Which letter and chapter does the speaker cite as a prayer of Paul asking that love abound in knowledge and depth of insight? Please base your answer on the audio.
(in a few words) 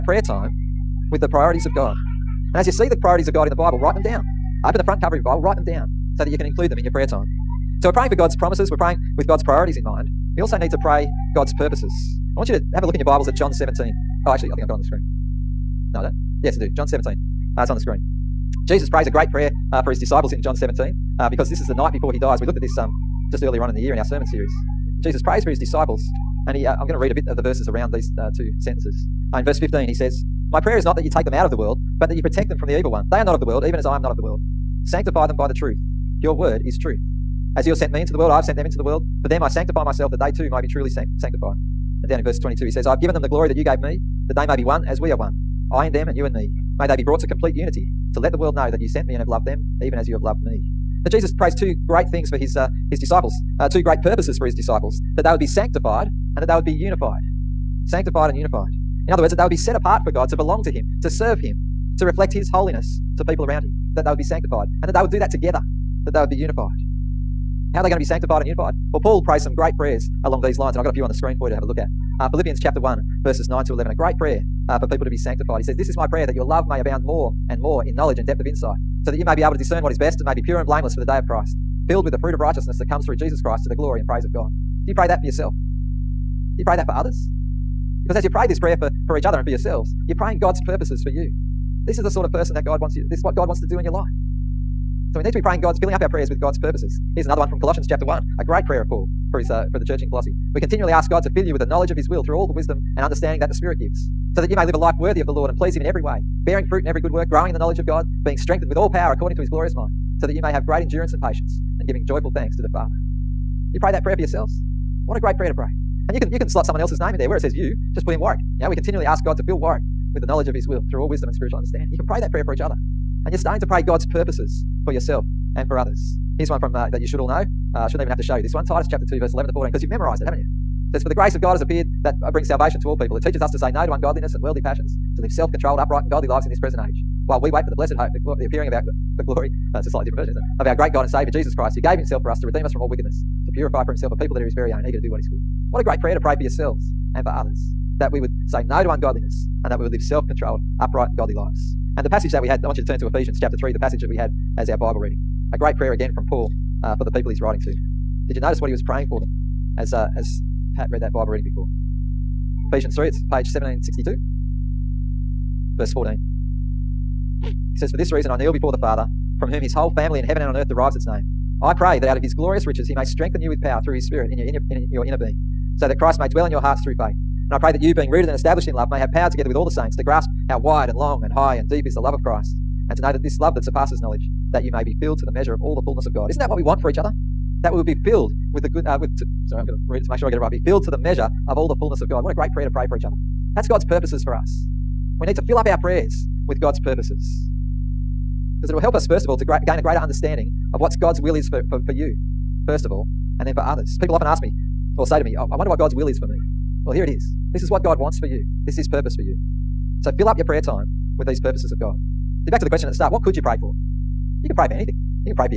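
Philippians chapter 1.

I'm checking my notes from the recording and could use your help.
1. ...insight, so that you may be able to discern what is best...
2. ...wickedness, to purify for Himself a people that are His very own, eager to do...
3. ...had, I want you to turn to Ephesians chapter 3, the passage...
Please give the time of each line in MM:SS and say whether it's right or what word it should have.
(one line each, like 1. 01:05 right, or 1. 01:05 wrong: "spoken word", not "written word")
1. 01:18 right
2. 02:22 right
3. 02:32 right.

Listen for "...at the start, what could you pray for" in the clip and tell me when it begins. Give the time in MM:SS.
03:32.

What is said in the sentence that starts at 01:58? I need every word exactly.
You know, we continually ask God to fill Warwick with the knowledge of his will through all wisdom and spiritual understanding.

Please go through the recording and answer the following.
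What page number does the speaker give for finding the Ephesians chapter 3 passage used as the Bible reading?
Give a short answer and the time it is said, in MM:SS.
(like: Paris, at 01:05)
1762, at 02:43.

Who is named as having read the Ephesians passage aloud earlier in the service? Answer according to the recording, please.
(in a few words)
Pat.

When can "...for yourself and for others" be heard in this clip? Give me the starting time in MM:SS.
02:04.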